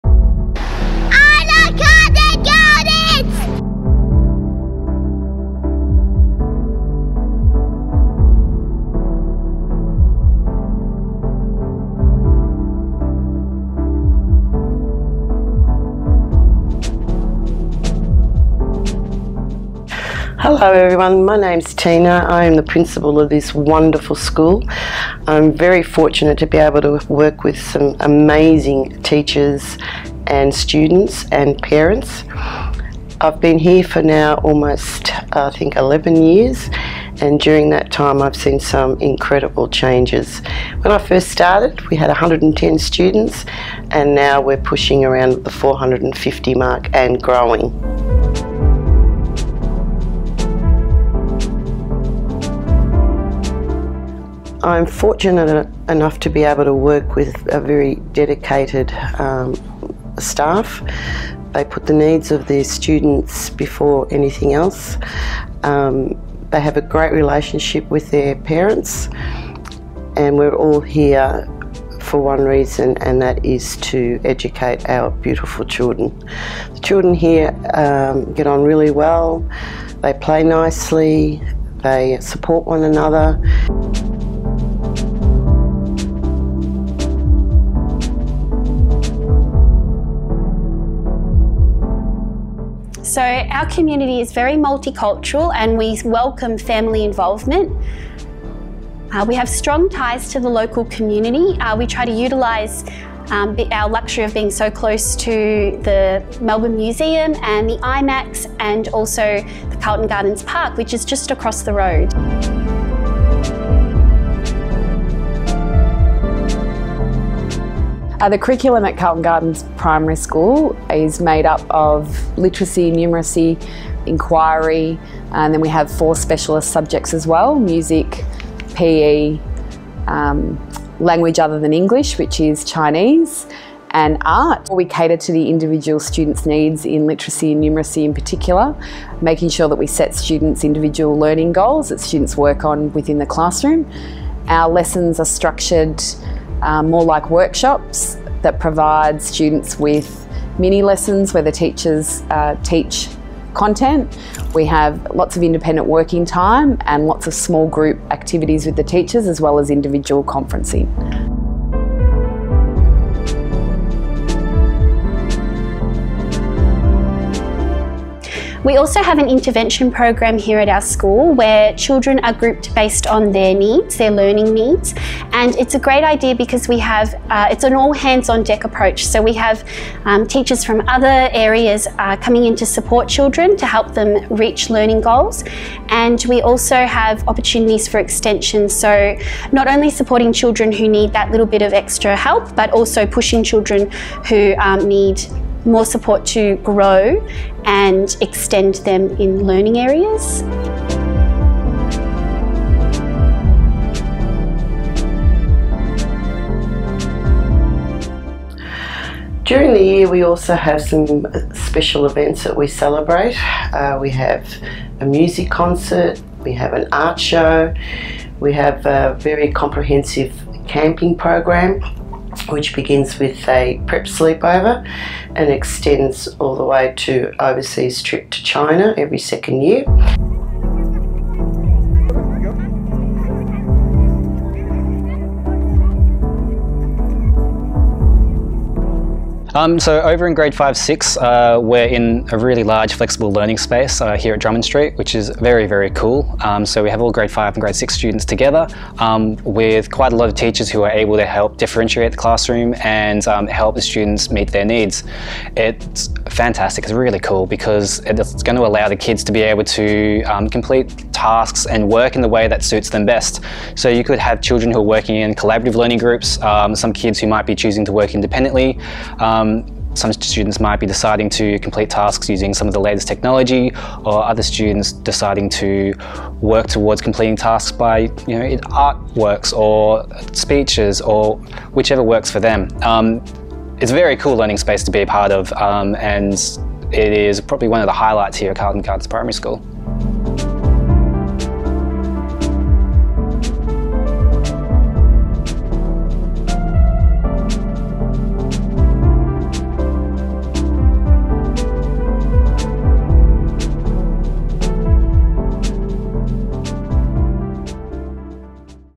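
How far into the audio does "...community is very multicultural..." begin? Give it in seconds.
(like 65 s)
93 s.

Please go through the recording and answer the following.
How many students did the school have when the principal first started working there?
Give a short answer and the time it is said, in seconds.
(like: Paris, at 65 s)
110, at 42 s.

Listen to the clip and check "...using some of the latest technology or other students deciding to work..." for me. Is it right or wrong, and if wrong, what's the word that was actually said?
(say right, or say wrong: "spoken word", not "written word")
right.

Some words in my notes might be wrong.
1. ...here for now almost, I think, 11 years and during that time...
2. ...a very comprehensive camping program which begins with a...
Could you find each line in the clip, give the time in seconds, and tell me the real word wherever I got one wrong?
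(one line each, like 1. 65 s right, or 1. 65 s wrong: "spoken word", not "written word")
1. 33 s right
2. 218 s right.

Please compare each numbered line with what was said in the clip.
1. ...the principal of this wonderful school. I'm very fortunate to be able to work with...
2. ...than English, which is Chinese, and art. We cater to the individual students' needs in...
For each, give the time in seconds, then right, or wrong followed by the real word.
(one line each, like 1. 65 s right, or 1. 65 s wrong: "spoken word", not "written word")
1. 22 s right
2. 131 s right.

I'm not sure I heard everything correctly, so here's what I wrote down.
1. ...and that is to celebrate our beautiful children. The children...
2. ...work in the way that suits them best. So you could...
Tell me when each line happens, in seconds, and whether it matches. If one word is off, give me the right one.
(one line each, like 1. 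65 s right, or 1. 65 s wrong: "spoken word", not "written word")
1. 72 s wrong: "educate", not "celebrate"
2. 261 s right.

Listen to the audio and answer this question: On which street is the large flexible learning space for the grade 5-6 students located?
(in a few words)
Drummond Street.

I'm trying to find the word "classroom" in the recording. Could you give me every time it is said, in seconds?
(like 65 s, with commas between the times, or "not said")
143 s, 252 s.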